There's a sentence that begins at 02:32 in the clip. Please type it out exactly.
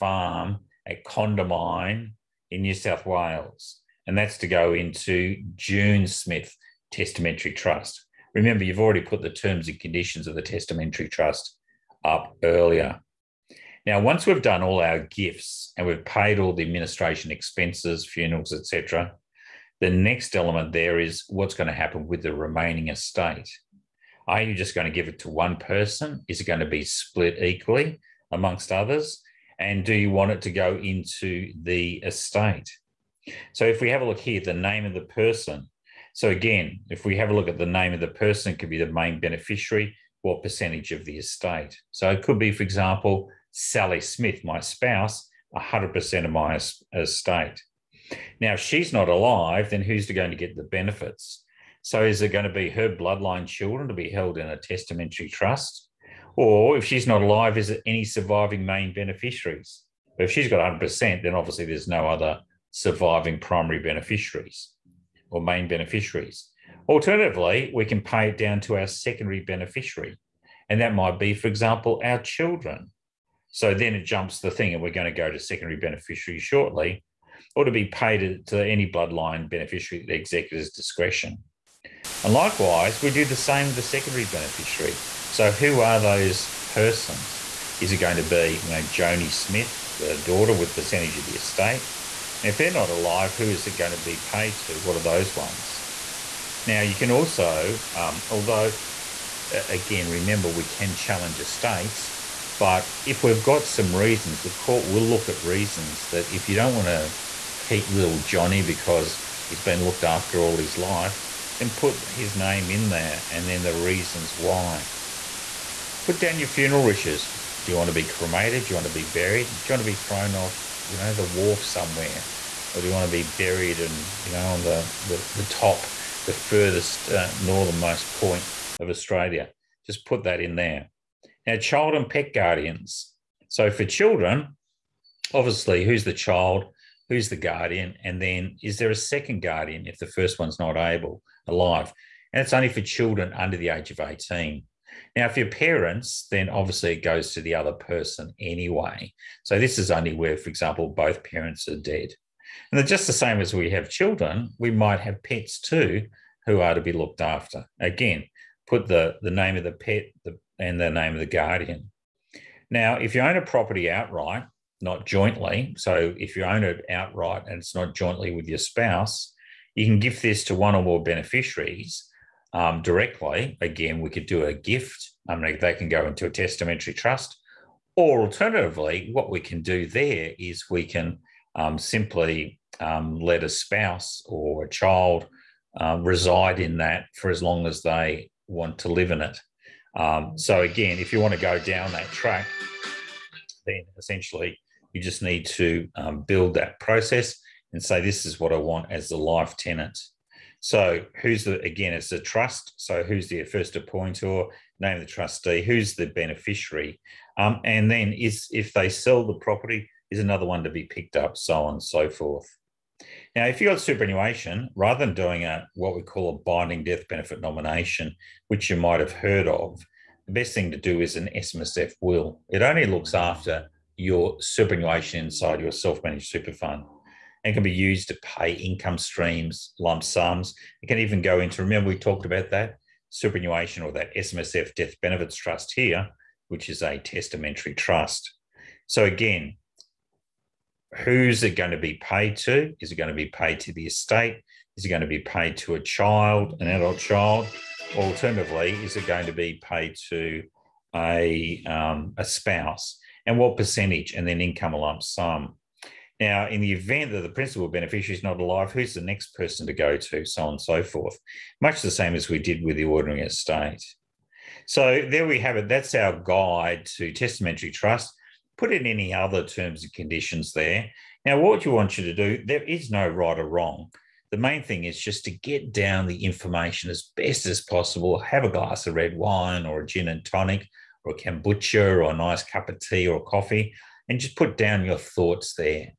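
And they're just the same as we have children, we might have pets too who are to be looked after.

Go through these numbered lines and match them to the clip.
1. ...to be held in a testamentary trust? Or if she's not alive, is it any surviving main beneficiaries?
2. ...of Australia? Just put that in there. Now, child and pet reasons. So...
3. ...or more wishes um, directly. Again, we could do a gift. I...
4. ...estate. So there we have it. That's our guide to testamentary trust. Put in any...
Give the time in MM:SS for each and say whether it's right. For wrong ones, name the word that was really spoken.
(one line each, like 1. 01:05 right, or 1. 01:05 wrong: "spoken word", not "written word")
1. 00:53 right
2. 02:08 wrong: "guardians", not "reasons"
3. 02:50 wrong: "beneficiaries", not "wishes"
4. 04:23 right.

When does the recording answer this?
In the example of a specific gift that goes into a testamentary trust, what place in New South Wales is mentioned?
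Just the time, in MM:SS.
00:01.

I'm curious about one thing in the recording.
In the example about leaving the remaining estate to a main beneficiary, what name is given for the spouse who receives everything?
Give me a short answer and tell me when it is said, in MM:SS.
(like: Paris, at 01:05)
Sally Smith, at 00:43.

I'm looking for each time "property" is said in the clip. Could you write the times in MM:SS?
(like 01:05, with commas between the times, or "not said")
02:43, 03:29.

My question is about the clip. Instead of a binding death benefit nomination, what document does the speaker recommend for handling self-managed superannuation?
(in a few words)
SMSF will.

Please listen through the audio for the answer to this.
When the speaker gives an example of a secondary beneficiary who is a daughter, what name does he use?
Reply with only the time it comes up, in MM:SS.
01:28.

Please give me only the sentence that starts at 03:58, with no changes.
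So again, who's it going to be paid to?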